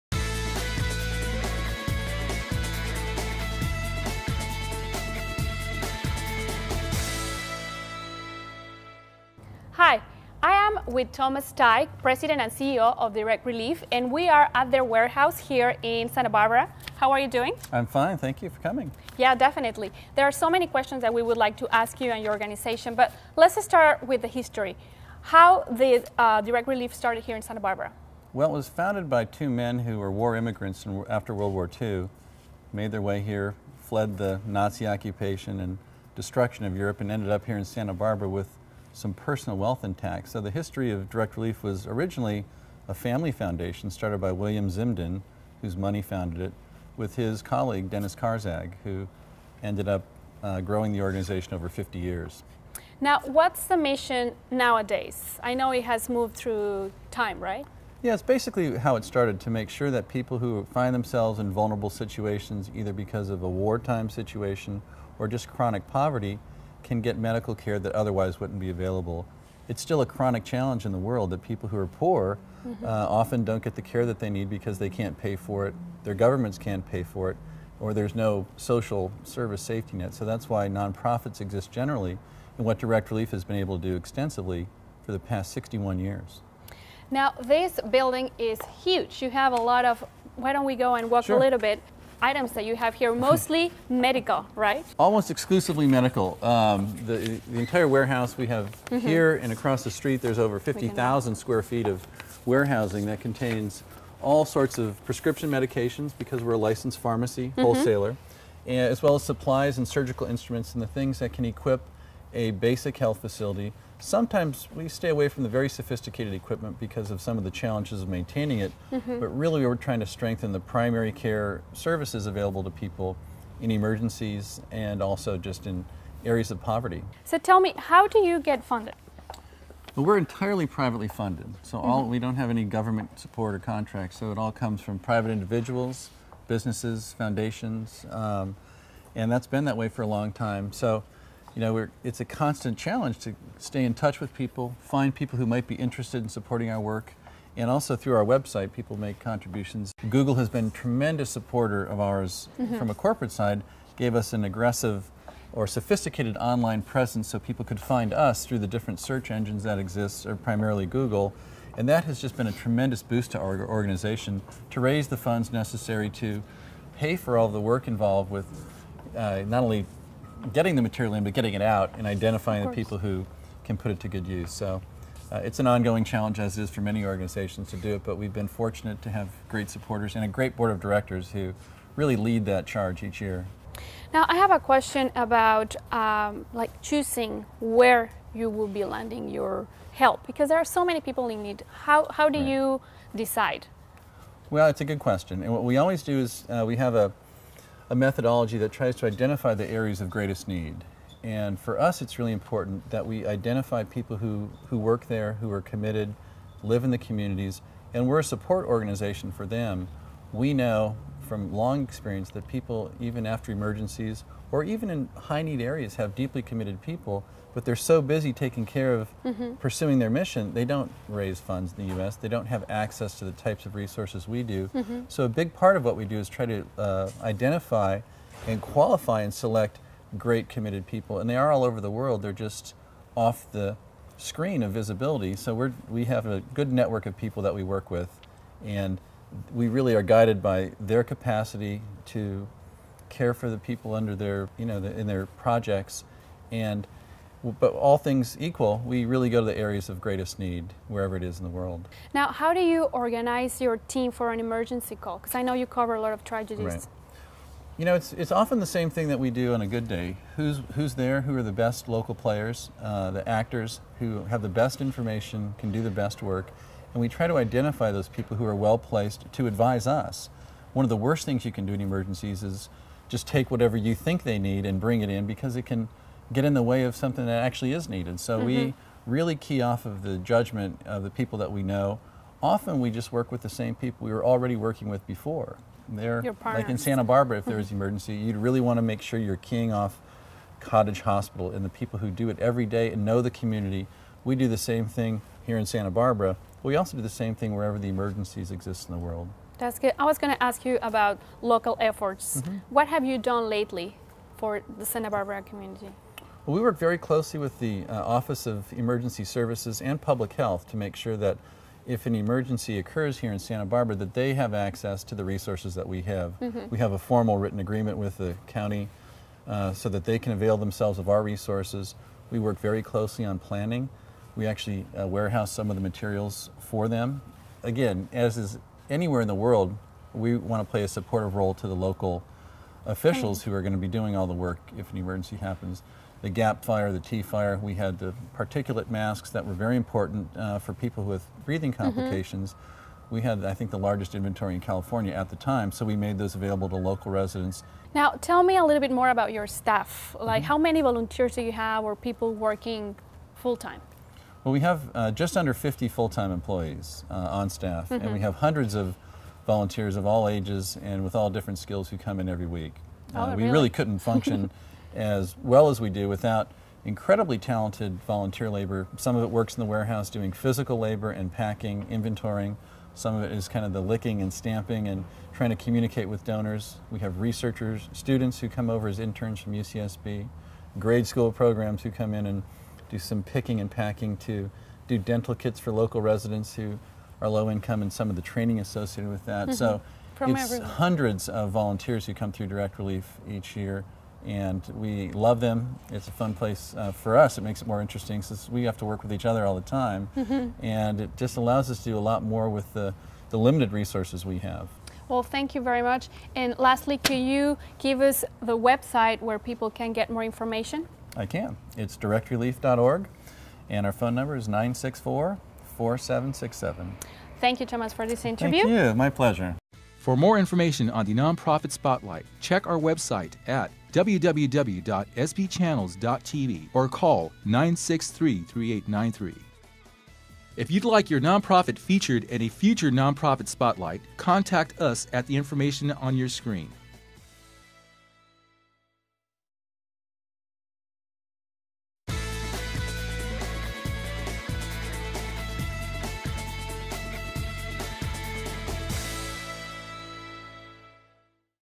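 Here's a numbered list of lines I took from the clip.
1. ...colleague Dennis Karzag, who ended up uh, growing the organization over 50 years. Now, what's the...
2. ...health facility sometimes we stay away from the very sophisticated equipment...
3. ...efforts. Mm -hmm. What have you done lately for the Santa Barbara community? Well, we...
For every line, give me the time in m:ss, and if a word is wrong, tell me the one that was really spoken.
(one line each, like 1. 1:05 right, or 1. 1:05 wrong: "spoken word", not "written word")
1. 0:47 right
2. 1:52 right
3. 5:01 right.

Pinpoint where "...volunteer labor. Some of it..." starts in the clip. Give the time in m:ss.
6:08.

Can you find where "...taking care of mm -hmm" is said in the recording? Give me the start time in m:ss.
3:38.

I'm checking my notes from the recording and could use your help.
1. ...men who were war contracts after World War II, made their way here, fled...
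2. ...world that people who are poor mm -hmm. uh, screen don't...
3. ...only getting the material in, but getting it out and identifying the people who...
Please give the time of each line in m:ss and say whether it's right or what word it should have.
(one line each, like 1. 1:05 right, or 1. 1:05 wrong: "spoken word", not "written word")
1. 0:29 wrong: "immigrants", not "contracts"
2. 1:10 wrong: "often", not "screen"
3. 2:49 right.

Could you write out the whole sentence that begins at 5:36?
The GAP fire, the Tea fire, we had the particulate masks that were very important uh, for people with breathing mm-hmm.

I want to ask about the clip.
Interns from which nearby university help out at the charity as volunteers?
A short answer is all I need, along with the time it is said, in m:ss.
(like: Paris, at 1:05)
UCSB, at 6:19.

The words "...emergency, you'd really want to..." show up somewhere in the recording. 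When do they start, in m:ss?
4:47.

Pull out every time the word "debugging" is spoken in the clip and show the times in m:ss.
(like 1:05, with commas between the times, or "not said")
not said.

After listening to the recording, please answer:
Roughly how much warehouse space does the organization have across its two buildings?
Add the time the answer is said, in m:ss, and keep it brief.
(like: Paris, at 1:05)
50,000 square feet, at 1:40.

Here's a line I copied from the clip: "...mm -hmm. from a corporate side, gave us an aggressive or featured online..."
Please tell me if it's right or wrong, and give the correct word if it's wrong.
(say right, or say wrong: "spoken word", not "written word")
wrong: "sophisticated", not "featured".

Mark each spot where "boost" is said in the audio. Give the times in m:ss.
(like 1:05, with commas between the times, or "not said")
2:43.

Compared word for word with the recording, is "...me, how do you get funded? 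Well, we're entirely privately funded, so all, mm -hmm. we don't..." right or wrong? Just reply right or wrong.
right.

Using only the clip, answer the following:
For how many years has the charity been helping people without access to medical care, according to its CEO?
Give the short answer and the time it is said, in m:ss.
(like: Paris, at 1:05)
61, at 1:25.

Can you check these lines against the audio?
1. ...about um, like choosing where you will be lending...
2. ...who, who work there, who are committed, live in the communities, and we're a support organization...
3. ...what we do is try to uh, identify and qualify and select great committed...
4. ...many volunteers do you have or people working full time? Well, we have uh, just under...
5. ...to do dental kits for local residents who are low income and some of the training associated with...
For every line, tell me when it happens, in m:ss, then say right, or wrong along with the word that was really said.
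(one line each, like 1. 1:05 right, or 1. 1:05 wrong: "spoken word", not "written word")
1. 3:05 right
2. 3:24 right
3. 3:45 right
4. 5:50 right
5. 6:24 right.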